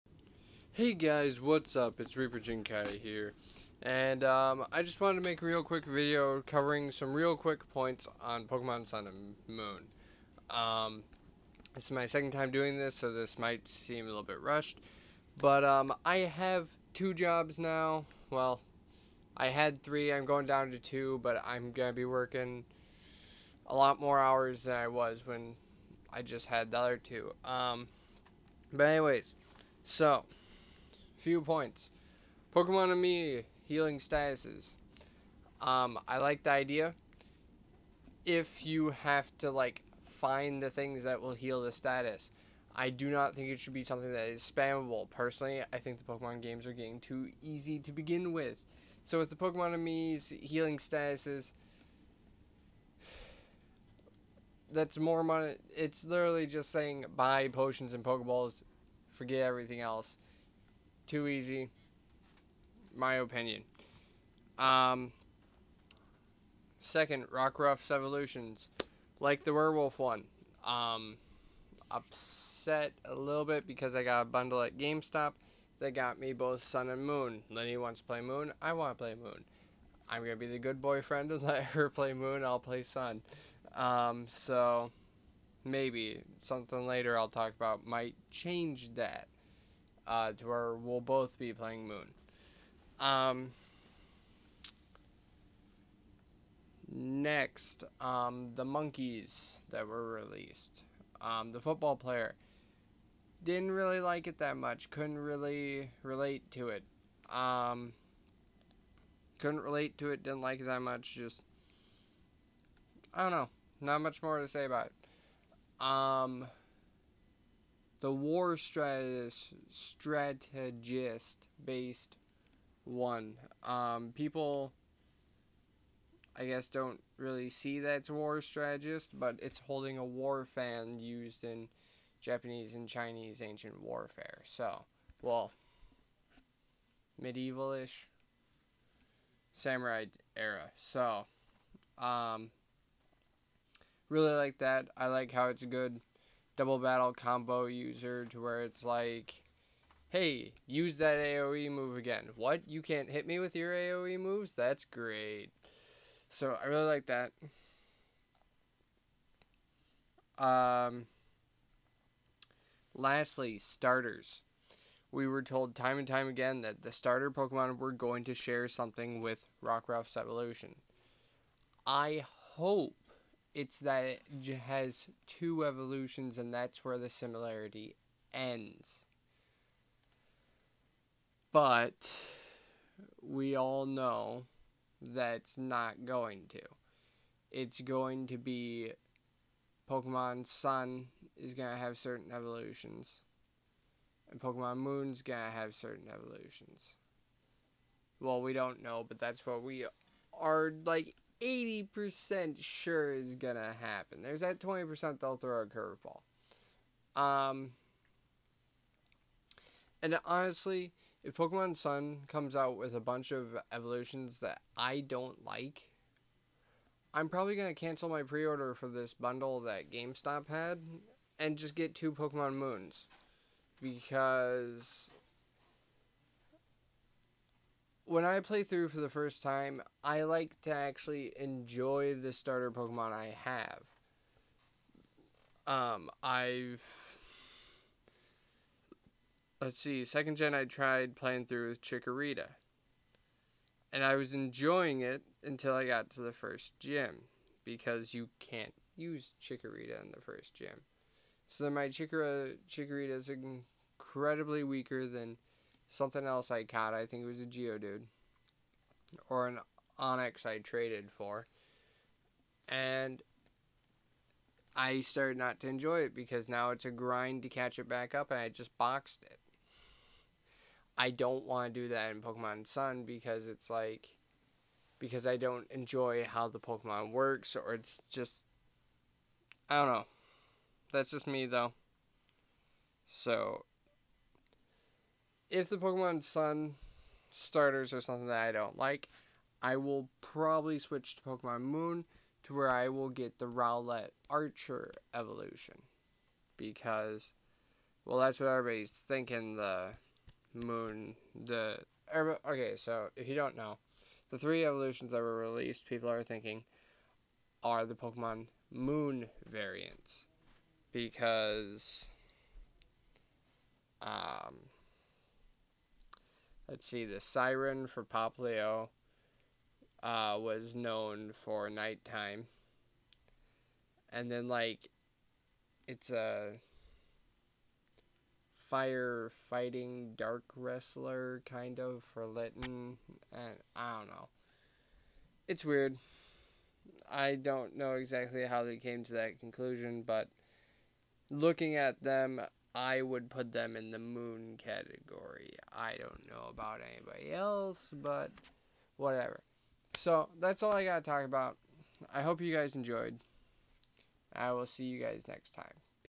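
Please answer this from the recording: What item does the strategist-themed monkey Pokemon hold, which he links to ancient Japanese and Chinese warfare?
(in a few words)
A war fan.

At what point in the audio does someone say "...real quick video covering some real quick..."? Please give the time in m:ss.
0:05.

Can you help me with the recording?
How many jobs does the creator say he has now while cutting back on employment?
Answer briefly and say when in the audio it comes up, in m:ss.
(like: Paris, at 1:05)
2, at 0:16.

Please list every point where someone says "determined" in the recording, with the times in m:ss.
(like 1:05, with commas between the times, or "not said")
not said.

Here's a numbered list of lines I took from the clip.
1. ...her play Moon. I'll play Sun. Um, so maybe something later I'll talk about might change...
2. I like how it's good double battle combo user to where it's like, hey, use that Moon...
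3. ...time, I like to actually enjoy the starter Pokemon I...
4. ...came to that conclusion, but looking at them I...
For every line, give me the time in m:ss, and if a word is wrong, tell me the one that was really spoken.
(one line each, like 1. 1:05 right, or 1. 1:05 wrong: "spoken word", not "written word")
1. 1:21 right
2. 2:24 wrong: "AoE", not "Moon"
3. 3:49 right
4. 5:38 right.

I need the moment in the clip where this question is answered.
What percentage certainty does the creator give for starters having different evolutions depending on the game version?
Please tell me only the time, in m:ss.
3:21.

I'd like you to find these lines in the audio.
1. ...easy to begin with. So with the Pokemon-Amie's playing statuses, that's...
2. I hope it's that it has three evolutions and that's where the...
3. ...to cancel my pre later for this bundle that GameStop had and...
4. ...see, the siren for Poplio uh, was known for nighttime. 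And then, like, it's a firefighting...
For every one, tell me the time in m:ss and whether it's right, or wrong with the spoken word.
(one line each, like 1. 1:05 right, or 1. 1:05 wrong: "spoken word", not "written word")
1. 0:47 wrong: "healing", not "playing"
2. 2:51 wrong: "two", not "three"
3. 3:37 wrong: "order", not "later"
4. 5:16 right.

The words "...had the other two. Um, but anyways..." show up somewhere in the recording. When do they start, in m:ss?
0:26.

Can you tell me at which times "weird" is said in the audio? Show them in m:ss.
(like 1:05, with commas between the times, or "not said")
5:35.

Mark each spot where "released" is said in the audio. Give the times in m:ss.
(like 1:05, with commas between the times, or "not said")
1:40, 5:05.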